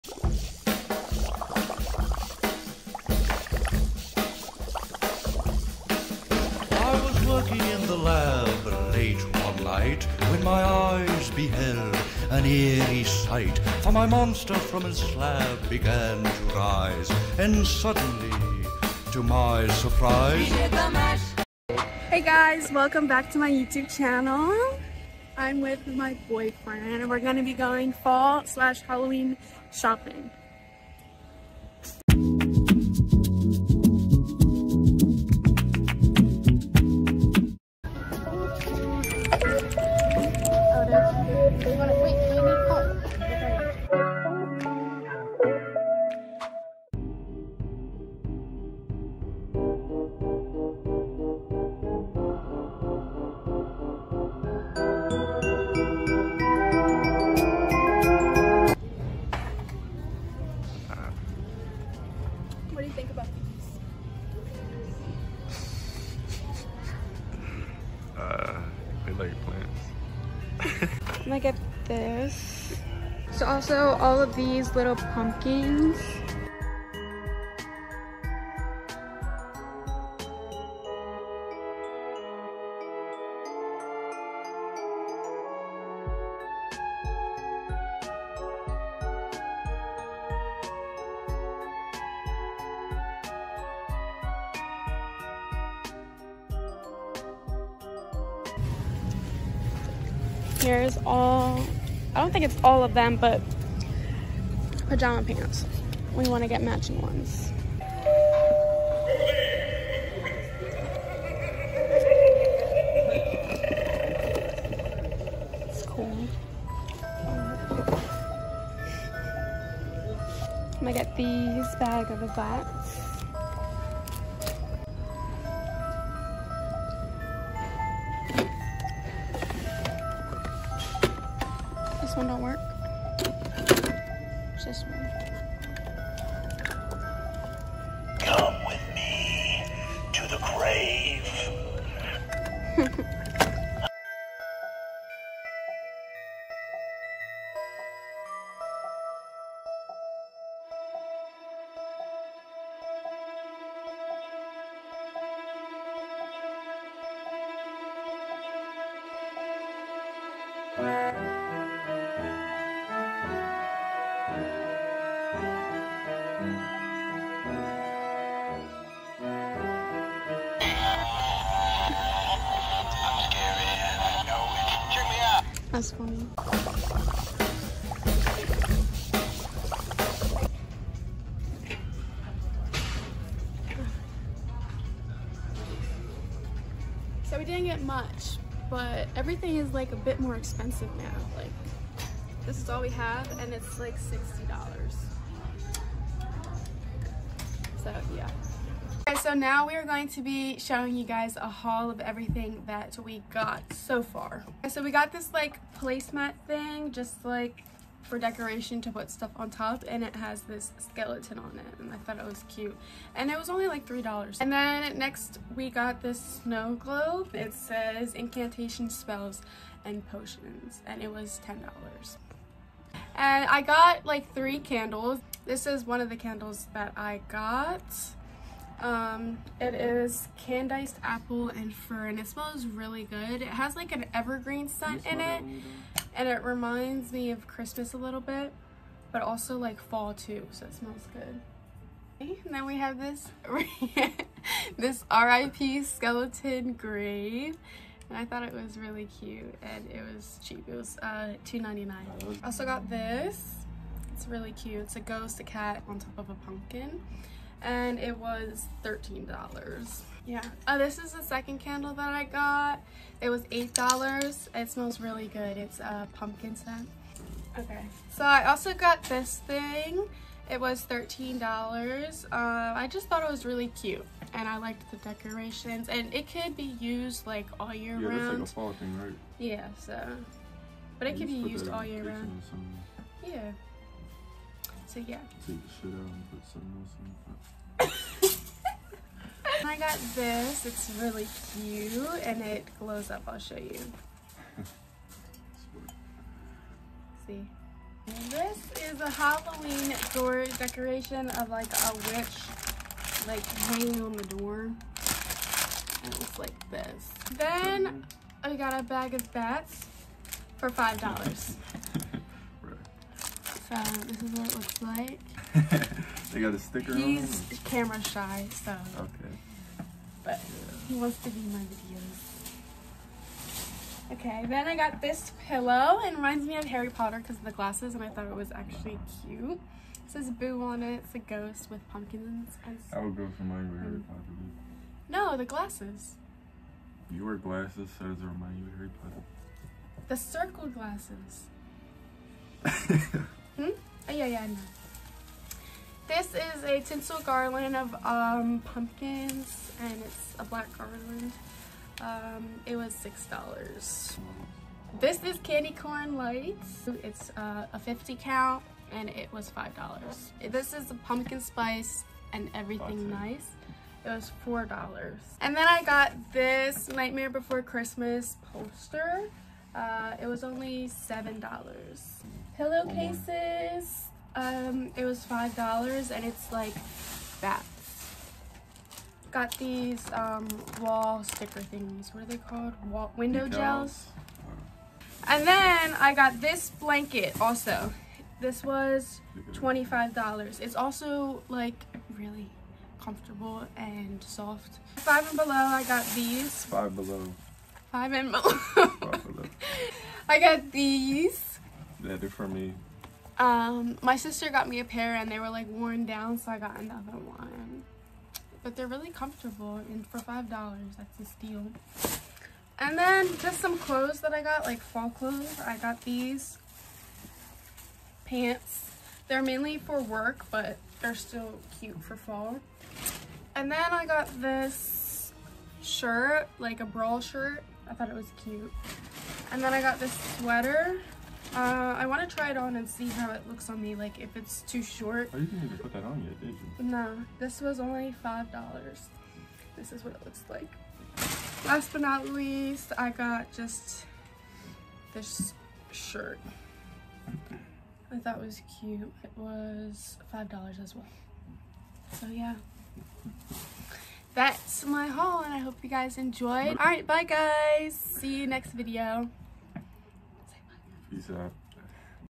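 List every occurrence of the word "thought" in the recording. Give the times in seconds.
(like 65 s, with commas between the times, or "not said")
211 s, 248 s, 273 s, 328 s, 427 s, 448 s.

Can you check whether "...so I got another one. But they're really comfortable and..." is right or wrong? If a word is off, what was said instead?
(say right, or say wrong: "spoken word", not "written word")
right.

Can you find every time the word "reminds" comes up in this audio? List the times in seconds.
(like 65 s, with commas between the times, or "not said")
236 s, 326 s, 338 s.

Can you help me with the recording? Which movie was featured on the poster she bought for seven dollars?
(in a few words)
Nightmare Before Christmas.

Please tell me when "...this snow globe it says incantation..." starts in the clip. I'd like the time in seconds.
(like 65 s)
216 s.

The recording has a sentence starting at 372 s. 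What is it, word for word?
Pillowcases, um, it was $5 and it's like bats.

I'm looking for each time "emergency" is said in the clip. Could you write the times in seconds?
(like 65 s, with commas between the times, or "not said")
not said.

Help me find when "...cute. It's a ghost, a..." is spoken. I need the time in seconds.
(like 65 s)
254 s.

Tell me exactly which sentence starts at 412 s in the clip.
And then just some clothes that I got, like fall clothes.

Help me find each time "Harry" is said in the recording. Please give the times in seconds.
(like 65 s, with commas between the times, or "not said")
326 s, 333 s, 338 s.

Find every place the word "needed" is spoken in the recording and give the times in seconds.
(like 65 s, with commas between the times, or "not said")
not said.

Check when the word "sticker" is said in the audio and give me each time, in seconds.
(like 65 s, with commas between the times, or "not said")
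316 s, 381 s.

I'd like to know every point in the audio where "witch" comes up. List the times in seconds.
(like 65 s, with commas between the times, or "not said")
301 s.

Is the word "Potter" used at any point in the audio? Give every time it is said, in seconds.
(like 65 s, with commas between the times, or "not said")
326 s, 334 s, 339 s.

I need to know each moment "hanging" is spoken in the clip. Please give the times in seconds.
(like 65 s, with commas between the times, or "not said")
303 s.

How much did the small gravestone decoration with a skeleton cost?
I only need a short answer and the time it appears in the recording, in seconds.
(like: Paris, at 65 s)
$2.99, at 251 s.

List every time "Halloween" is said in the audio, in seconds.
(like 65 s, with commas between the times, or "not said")
28 s, 299 s.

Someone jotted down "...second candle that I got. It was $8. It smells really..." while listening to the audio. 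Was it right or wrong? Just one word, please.
right.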